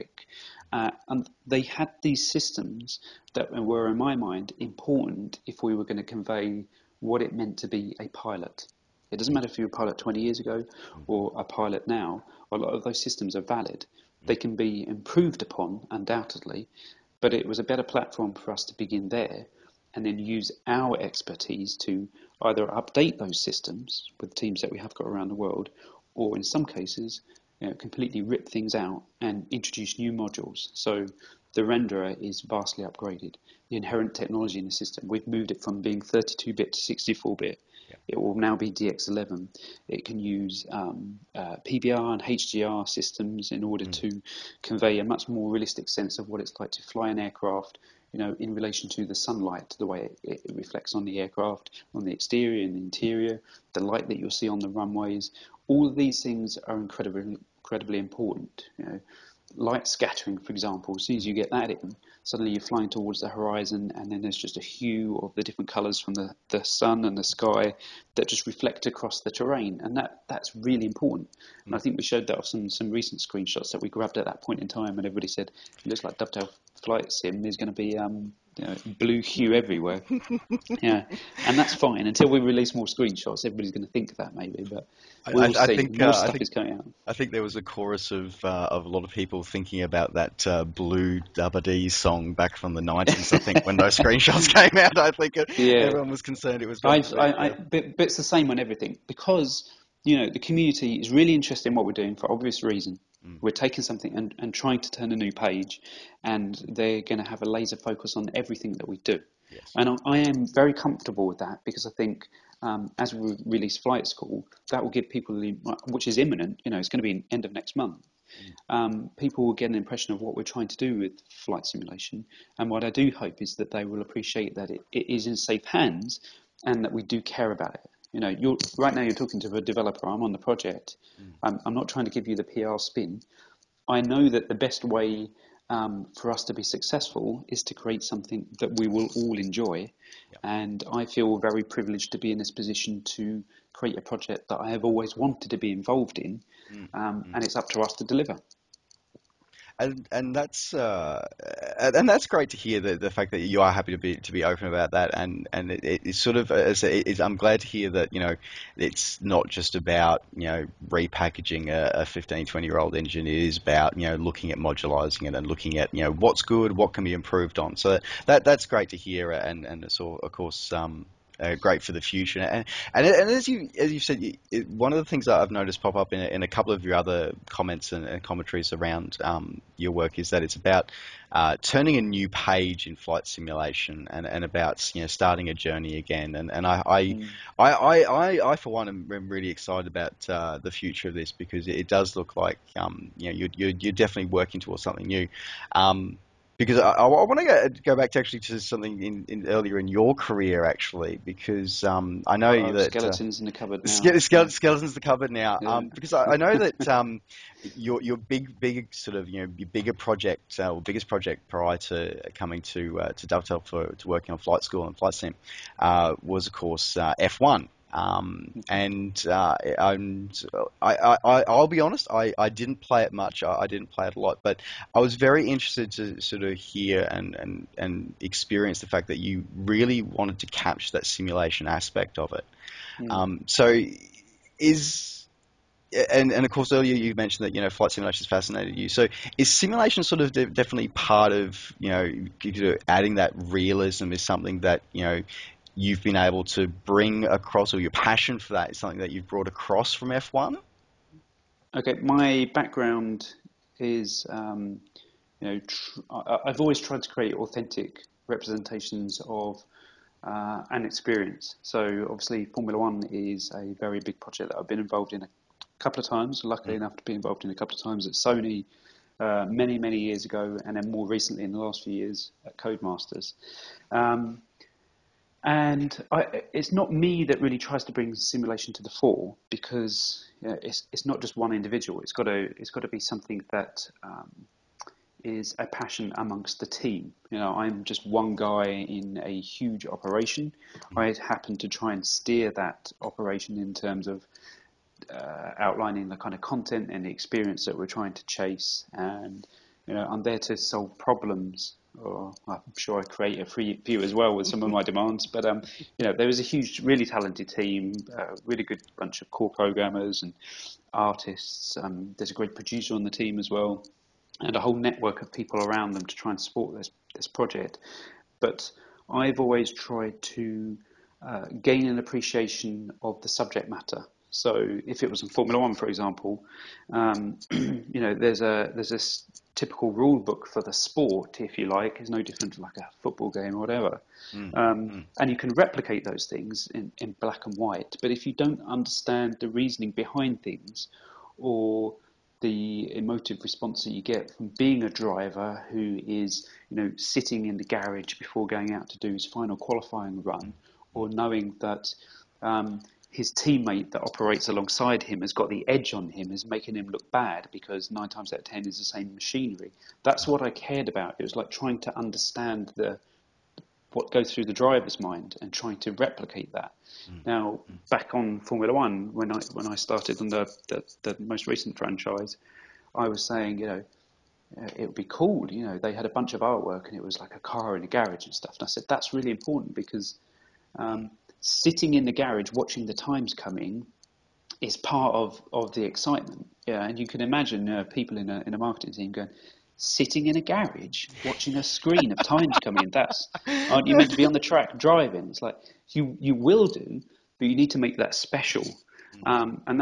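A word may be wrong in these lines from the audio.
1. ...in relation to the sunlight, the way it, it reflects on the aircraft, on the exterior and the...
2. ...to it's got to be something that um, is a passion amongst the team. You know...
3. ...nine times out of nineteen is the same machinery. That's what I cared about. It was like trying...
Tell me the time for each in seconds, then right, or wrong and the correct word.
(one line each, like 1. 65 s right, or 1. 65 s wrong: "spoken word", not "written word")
1. 48 s right
2. 282 s right
3. 357 s wrong: "ten", not "nineteen".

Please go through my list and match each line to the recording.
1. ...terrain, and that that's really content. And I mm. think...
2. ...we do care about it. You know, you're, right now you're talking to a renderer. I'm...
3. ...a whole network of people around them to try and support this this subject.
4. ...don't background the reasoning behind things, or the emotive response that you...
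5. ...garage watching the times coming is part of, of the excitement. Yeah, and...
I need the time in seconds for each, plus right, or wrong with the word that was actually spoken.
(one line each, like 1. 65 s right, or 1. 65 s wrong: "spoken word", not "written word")
1. 69 s wrong: "important", not "content"
2. 126 s wrong: "developer", not "renderer"
3. 314 s wrong: "project", not "subject"
4. 338 s wrong: "understand", not "background"
5. 382 s right.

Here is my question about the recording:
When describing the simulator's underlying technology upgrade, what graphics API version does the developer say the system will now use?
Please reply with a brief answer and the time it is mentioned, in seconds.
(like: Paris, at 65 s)
DX11, at 38 s.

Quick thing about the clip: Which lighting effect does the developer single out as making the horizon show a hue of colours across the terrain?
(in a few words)
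light scattering.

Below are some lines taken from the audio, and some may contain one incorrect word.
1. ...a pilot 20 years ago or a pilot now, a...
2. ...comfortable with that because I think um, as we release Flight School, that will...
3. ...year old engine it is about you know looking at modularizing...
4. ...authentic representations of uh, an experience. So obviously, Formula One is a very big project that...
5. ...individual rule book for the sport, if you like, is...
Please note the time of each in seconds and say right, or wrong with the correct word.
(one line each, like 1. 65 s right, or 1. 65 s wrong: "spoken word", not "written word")
1. 9 s right
2. 110 s right
3. 162 s right
4. 257 s right
5. 329 s wrong: "typical", not "individual".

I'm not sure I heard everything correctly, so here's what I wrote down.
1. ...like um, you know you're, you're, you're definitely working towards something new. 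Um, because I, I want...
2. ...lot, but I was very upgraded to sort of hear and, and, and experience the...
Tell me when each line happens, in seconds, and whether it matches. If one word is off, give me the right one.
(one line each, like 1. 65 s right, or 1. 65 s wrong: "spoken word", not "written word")
1. 192 s right
2. 224 s wrong: "interested", not "upgraded".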